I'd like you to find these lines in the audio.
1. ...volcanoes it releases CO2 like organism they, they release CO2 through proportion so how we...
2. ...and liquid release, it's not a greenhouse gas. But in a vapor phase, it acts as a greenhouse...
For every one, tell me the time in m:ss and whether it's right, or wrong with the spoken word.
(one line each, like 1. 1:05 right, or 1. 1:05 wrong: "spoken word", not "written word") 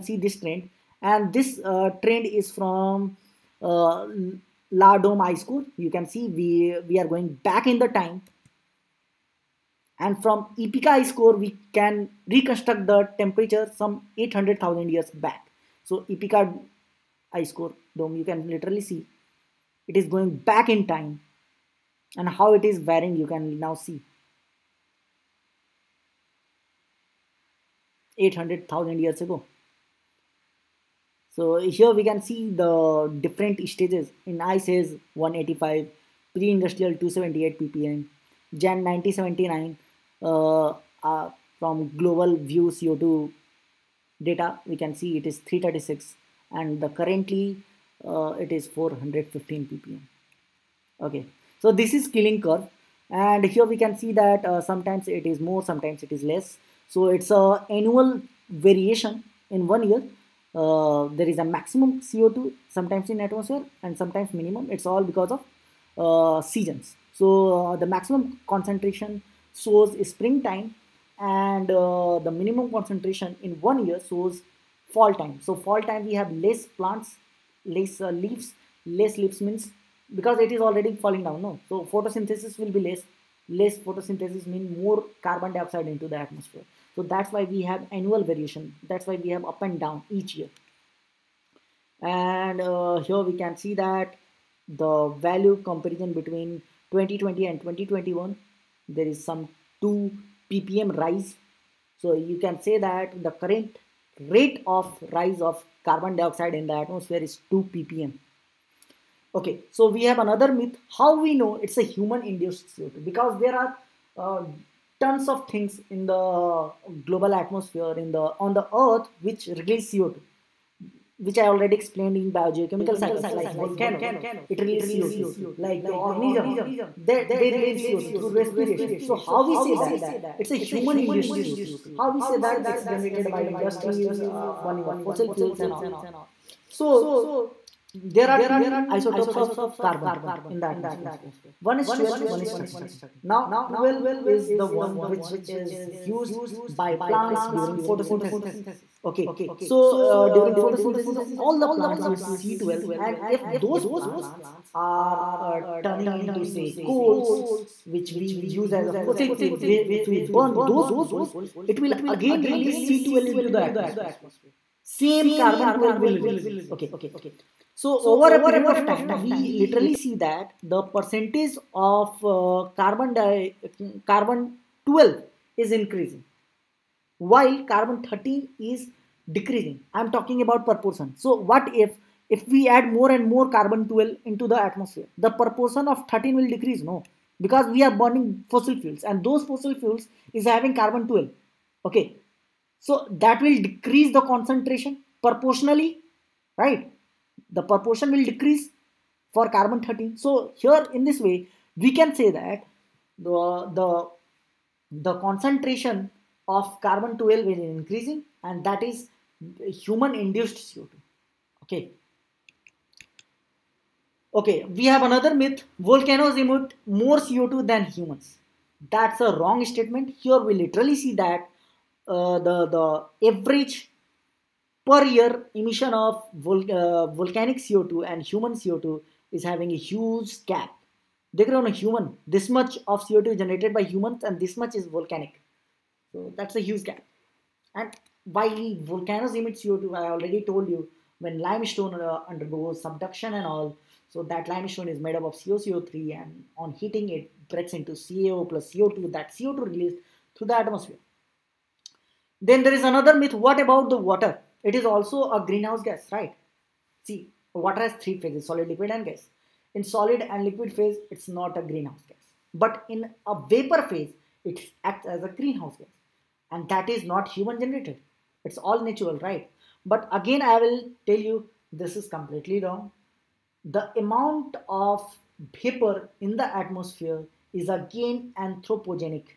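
1. 2:03 wrong: "respiration", not "proportion"
2. 4:20 wrong: "phase", not "release".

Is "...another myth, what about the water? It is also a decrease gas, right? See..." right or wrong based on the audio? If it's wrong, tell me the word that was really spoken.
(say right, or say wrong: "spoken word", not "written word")
wrong: "greenhouse", not "decrease".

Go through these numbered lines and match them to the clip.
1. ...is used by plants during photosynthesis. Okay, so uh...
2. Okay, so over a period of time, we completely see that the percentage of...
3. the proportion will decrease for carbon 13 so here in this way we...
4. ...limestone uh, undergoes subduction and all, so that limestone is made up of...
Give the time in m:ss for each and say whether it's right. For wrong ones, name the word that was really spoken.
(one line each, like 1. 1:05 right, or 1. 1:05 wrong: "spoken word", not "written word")
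1. 2:25 right
2. 2:46 wrong: "literally", not "completely"
3. 3:17 right
4. 4:01 right.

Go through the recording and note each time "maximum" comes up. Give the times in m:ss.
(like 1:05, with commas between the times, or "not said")
1:01, 1:07.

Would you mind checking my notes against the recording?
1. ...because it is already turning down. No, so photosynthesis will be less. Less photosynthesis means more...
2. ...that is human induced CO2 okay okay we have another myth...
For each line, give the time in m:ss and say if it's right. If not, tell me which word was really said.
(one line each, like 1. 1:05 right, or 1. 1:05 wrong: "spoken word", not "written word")
1. 1:20 wrong: "falling", not "turning"
2. 3:28 right.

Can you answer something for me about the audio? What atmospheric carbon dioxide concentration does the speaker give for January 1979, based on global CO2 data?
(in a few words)
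336 ppm.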